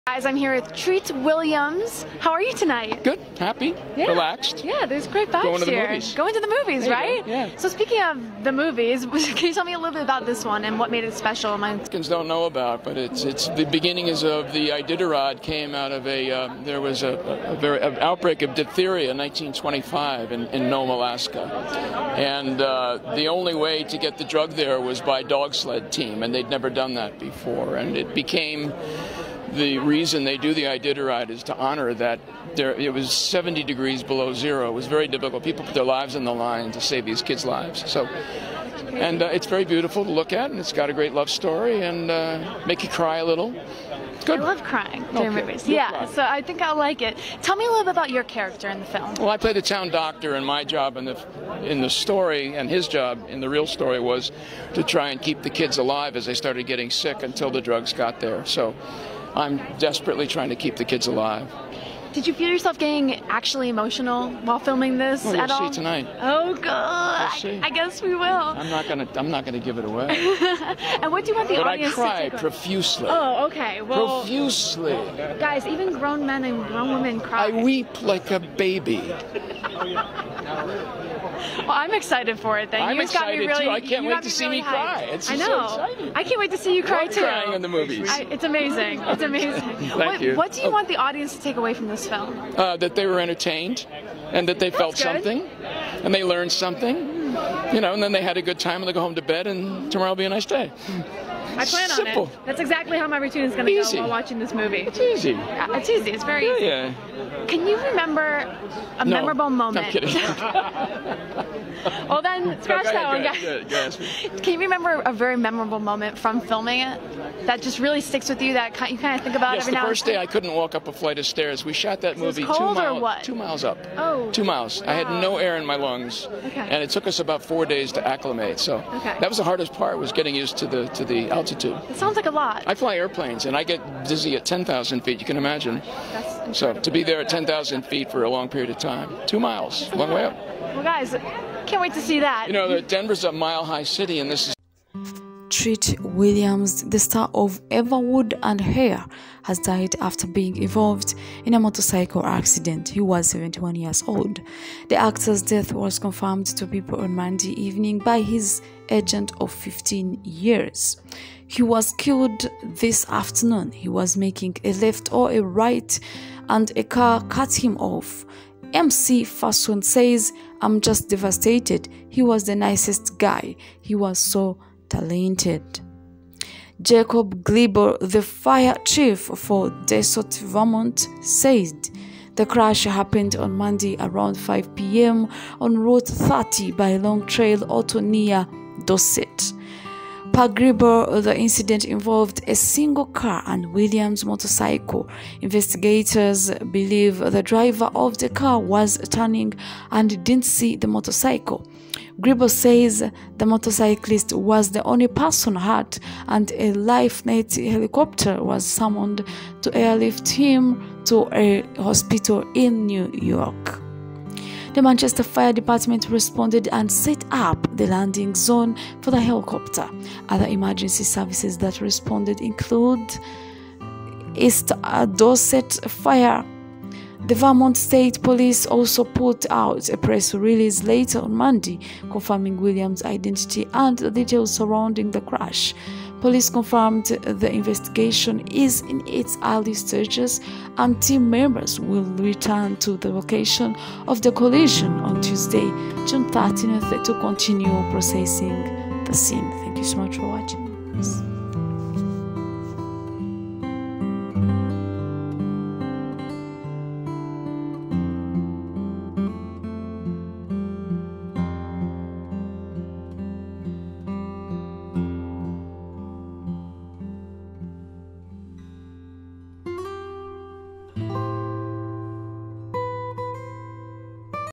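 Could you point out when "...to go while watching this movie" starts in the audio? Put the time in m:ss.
1:43.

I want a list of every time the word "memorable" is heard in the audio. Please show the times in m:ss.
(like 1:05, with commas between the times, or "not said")
1:49, 1:55.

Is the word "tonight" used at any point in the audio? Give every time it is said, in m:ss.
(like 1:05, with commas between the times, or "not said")
0:02, 1:05.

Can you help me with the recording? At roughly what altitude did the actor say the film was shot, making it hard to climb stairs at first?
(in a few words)
2 miles.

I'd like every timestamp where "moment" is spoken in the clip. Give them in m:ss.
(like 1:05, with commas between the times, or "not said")
1:49, 1:55.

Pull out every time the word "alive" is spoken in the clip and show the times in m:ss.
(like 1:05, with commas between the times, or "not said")
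0:55, 1:01.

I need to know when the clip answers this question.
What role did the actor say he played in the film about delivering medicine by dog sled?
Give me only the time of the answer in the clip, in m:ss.
0:49.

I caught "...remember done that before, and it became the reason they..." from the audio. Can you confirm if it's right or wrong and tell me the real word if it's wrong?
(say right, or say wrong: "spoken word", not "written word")
wrong: "never", not "remember".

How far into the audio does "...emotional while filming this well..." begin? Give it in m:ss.
1:03.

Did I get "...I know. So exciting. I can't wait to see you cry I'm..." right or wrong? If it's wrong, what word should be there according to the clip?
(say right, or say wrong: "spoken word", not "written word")
right.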